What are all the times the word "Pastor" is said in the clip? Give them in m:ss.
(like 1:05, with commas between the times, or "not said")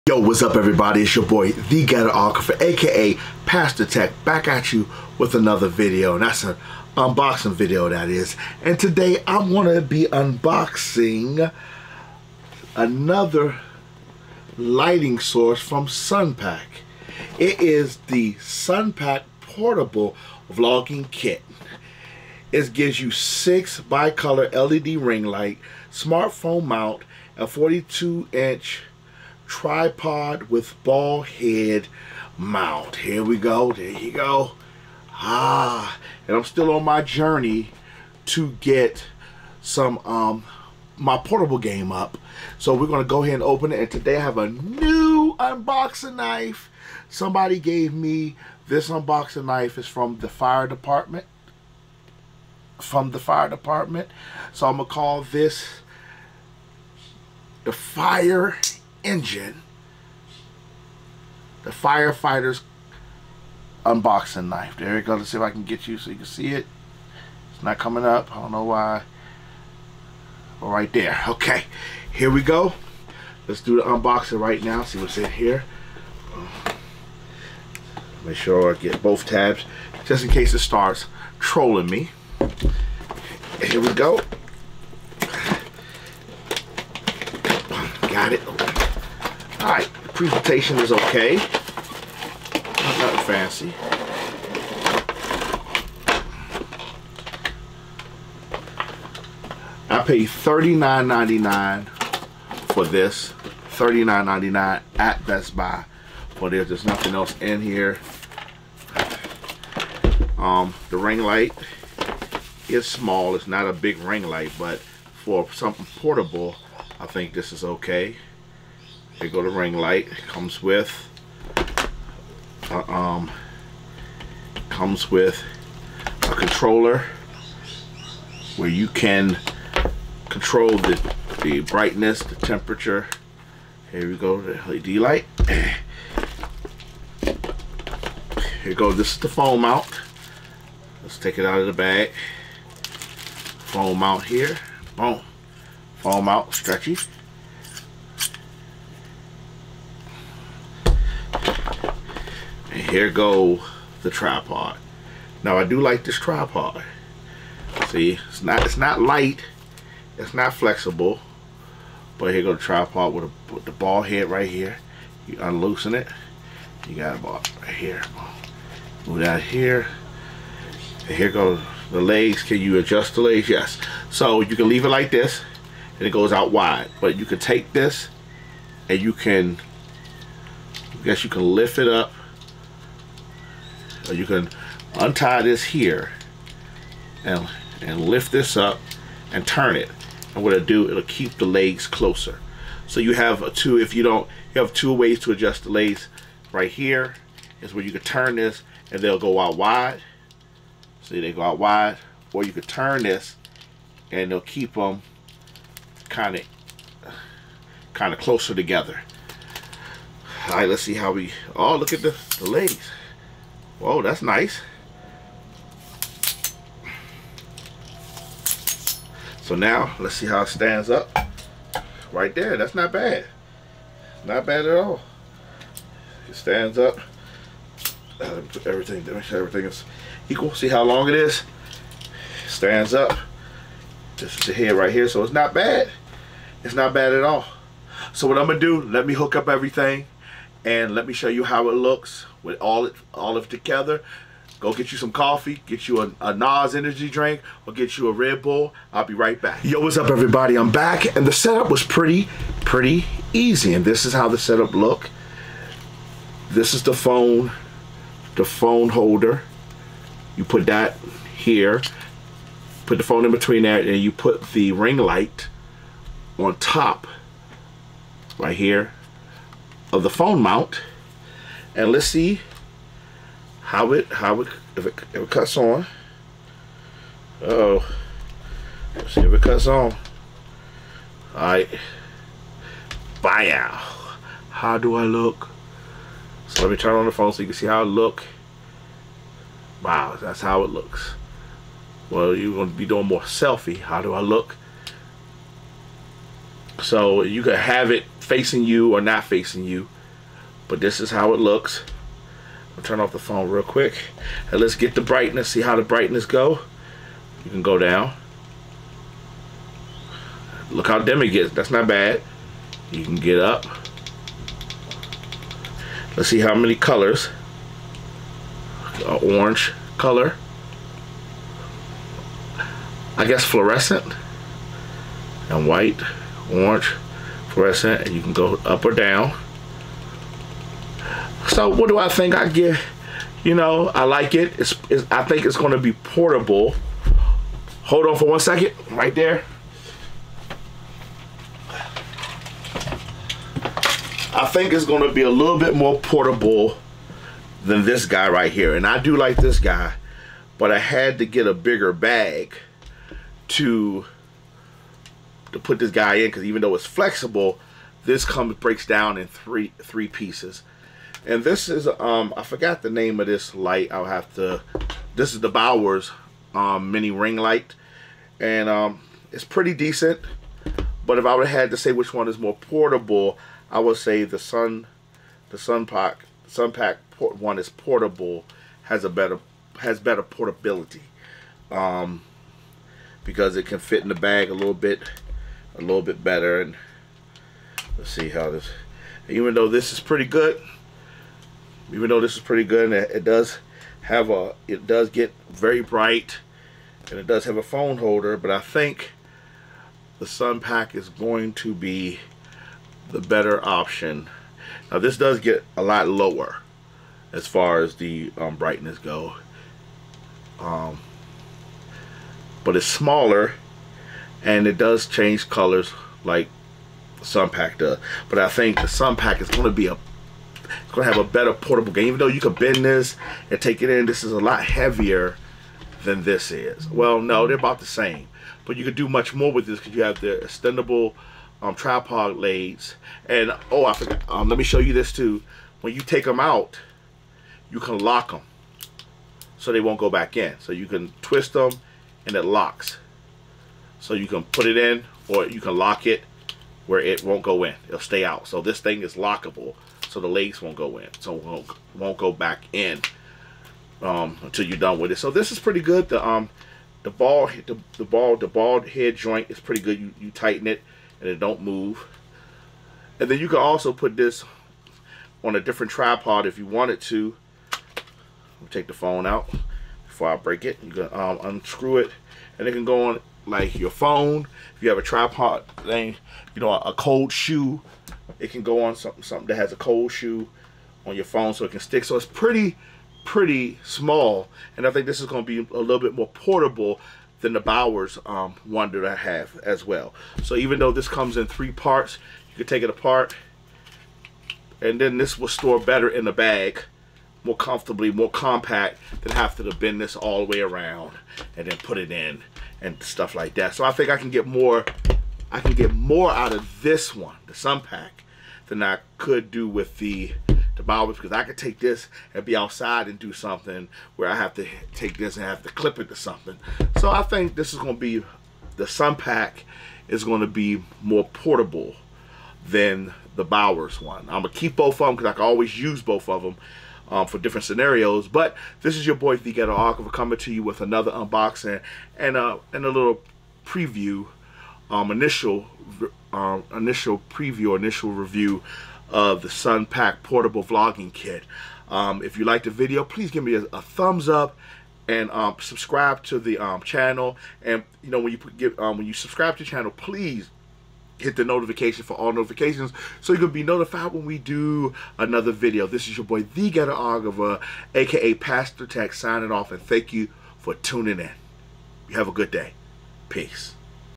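0:03, 9:18.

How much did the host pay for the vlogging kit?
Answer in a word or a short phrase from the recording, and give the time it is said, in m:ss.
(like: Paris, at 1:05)
$39.99, at 1:43.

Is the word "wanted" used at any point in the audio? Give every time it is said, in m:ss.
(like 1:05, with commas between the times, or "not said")
7:46.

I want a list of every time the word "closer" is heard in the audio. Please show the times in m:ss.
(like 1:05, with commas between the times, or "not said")
3:11, 3:28.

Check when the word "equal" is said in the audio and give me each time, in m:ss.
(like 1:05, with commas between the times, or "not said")
3:50.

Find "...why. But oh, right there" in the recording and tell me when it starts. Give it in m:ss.
1:08.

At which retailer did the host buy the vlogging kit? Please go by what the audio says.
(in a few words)
Best Buy.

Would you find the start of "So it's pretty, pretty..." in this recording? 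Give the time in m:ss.
8:02.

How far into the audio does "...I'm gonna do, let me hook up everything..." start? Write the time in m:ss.
3:58.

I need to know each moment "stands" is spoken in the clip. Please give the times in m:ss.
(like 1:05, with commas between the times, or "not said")
3:40, 3:46, 3:52.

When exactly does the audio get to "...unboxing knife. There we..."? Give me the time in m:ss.
1:03.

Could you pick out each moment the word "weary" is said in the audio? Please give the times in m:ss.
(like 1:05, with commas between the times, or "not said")
not said.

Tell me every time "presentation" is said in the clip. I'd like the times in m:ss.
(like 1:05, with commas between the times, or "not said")
1:30.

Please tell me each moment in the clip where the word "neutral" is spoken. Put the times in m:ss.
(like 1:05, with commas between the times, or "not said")
not said.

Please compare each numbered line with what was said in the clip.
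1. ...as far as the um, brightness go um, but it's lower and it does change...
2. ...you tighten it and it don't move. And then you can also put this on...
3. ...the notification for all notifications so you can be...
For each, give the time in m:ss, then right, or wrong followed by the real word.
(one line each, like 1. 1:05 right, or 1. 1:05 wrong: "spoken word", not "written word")
1. 6:47 wrong: "smaller", not "lower"
2. 7:40 right
3. 9:11 right.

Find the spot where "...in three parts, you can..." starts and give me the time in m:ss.
8:11.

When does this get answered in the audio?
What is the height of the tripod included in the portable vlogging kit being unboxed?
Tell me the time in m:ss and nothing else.
0:27.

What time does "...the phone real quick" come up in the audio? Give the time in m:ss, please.
5:03.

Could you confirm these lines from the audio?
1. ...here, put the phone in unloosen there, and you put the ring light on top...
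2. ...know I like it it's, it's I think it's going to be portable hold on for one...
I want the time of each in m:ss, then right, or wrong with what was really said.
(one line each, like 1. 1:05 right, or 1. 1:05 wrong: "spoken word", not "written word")
1. 4:21 wrong: "between", not "unloosen"
2. 5:33 right.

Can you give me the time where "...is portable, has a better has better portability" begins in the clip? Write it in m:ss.
6:17.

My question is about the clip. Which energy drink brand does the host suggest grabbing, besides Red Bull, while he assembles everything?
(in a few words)
Nas.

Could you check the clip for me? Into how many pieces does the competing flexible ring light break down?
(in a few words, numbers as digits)
3.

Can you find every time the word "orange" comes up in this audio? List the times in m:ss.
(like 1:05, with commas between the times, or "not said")
5:19, 5:26.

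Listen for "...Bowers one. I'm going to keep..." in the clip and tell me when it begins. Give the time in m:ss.
8:43.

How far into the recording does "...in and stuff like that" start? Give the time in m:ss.
8:22.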